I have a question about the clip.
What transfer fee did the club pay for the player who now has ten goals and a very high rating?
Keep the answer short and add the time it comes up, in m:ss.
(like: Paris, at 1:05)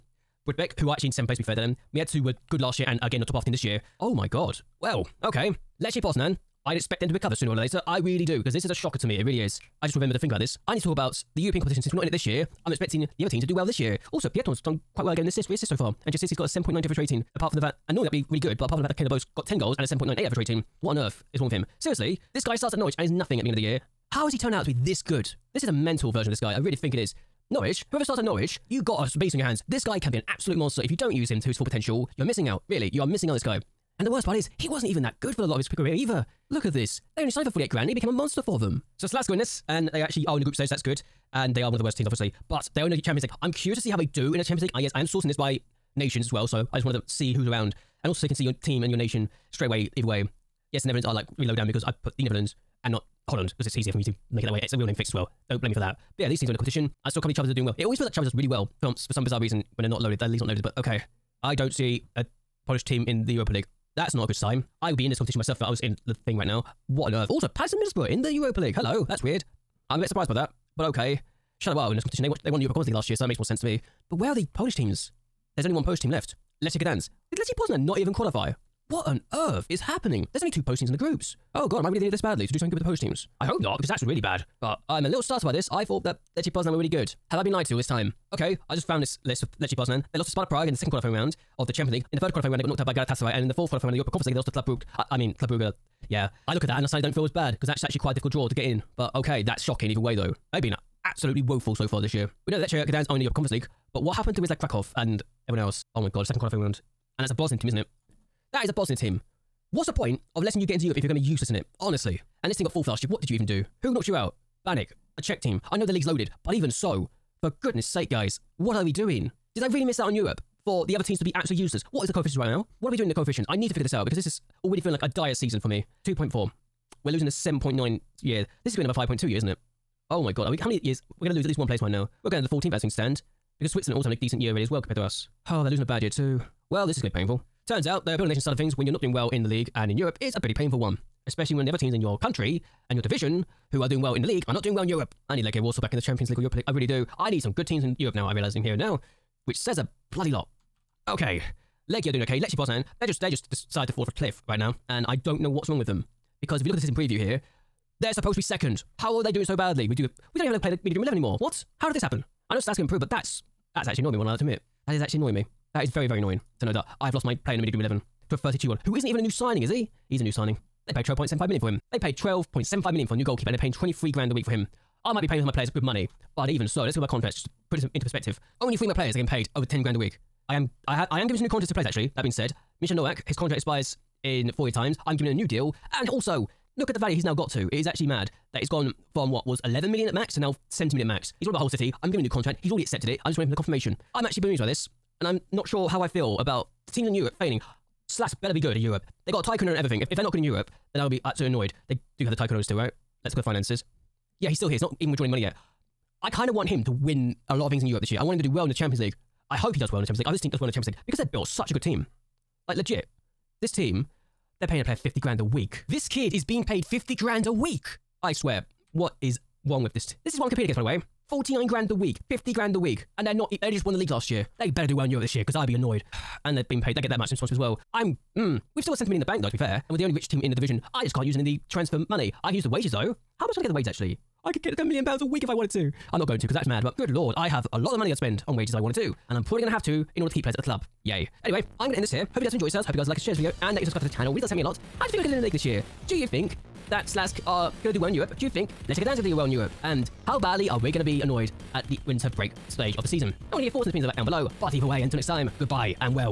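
48 grand, at 0:37.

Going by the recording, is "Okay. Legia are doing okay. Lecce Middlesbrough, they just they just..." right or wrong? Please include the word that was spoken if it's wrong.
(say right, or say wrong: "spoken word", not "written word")
wrong: "Poznan", not "Middlesbrough".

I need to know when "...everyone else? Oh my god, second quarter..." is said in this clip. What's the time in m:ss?
1:45.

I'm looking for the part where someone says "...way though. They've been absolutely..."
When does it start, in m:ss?
1:39.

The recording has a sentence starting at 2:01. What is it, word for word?
What is the coefficients right now?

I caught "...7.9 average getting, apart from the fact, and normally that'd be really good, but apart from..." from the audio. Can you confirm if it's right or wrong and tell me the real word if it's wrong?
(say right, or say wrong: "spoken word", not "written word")
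wrong: "rating", not "getting".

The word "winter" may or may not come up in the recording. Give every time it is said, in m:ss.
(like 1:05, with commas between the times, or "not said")
4:12.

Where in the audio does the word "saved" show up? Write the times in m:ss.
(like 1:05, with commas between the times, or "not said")
not said.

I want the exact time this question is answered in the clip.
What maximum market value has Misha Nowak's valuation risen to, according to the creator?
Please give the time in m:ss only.
3:10.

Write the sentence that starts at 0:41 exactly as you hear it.
And they are one of the worst teams, obviously.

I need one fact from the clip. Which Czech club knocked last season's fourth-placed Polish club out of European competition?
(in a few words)
Baník.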